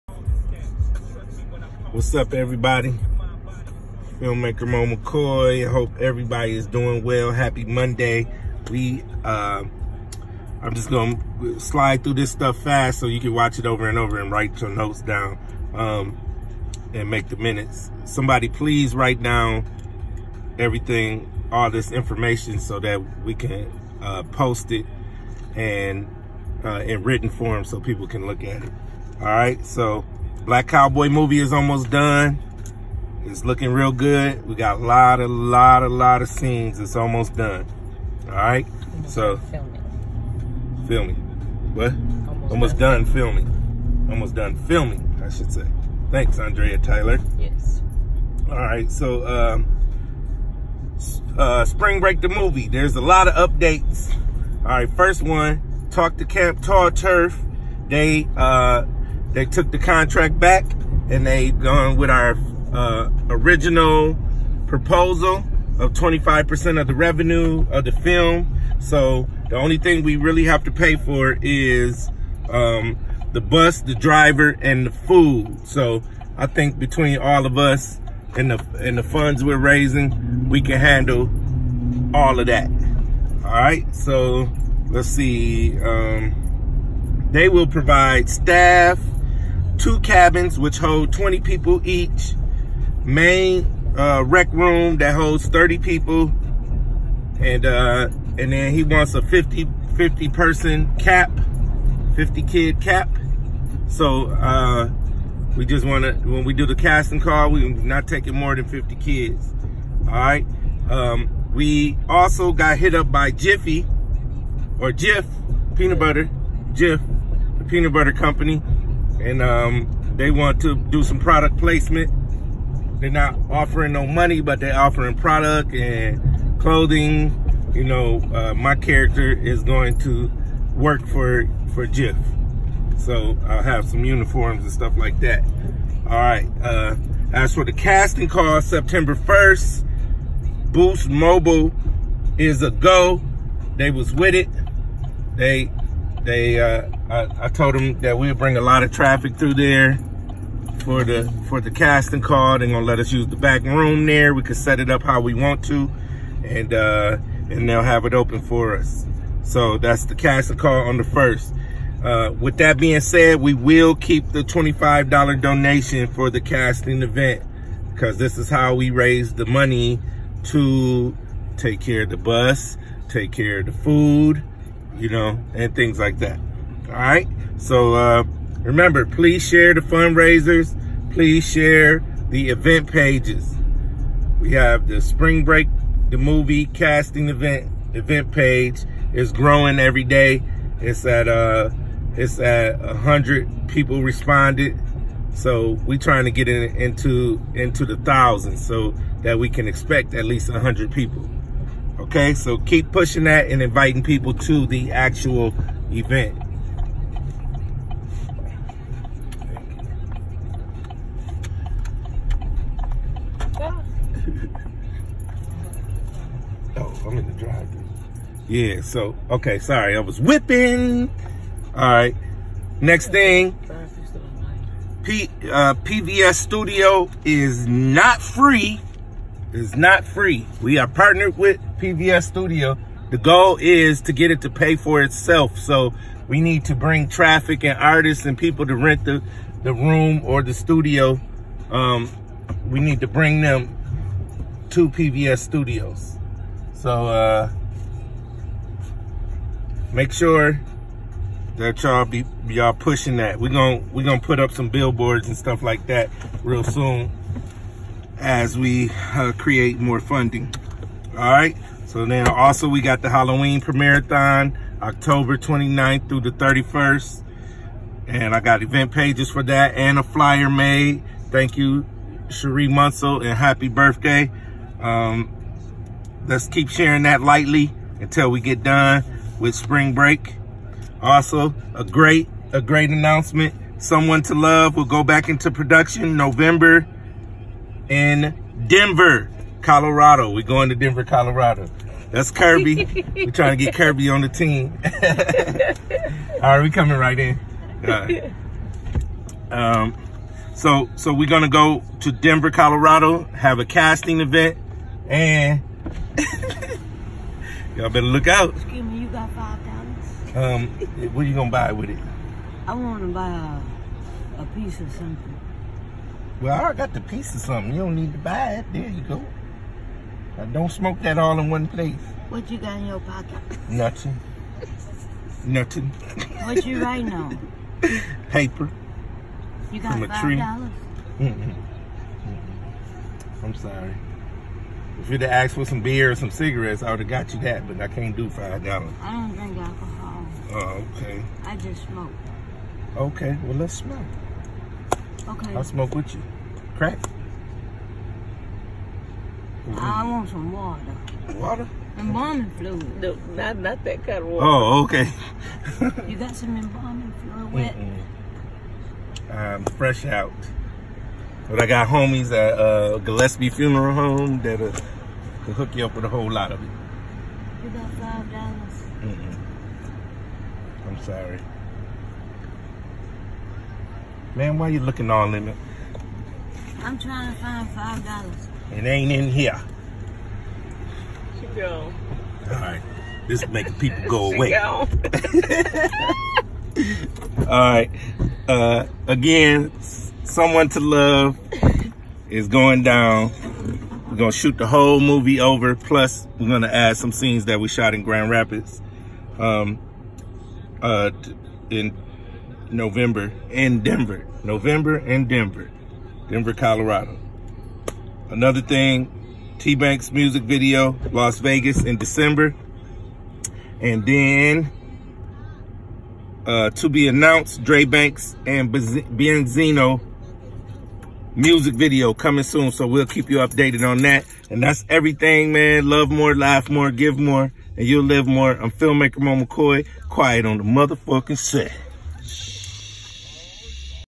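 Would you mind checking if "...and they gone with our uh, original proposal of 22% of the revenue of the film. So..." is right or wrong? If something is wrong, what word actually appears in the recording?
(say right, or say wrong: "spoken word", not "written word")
wrong: "25", not "22".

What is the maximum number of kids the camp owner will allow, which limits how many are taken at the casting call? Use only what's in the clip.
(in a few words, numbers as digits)
50.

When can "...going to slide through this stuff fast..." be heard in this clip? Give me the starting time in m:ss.
0:10.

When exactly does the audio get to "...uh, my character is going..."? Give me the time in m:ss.
2:08.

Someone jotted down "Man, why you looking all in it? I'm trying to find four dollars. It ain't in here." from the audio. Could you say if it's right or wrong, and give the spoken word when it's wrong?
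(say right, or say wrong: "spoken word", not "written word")
wrong: "five", not "four".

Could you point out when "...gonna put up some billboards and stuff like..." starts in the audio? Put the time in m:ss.
4:14.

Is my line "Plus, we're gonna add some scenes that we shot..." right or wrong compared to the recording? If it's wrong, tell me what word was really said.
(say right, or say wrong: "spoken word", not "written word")
right.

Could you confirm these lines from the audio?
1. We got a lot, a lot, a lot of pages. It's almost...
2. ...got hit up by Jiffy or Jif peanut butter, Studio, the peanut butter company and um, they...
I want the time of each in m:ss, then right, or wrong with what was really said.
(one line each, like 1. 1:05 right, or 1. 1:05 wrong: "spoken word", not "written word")
1. 0:34 wrong: "scenes", not "pages"
2. 1:52 wrong: "Jif", not "Studio".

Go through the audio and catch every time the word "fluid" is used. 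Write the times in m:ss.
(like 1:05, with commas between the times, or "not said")
5:52, 5:57.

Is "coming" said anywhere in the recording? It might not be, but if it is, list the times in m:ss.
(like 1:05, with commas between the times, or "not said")
4:56, 7:02.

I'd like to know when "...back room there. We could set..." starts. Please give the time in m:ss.
2:33.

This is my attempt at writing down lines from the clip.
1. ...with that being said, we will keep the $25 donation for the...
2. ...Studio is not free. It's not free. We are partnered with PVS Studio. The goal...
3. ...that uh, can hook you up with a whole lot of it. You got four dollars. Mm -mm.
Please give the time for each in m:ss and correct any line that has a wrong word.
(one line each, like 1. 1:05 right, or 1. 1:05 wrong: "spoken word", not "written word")
1. 2:42 right
2. 3:46 right
3. 6:04 wrong: "five", not "four".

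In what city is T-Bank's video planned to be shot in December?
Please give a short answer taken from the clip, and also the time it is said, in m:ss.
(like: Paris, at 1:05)
Las Vegas, at 6:51.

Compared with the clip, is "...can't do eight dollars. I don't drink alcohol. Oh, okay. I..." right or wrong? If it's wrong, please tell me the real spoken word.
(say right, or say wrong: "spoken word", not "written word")
wrong: "five", not "eight".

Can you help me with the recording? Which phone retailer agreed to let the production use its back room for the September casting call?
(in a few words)
Boost Mobile.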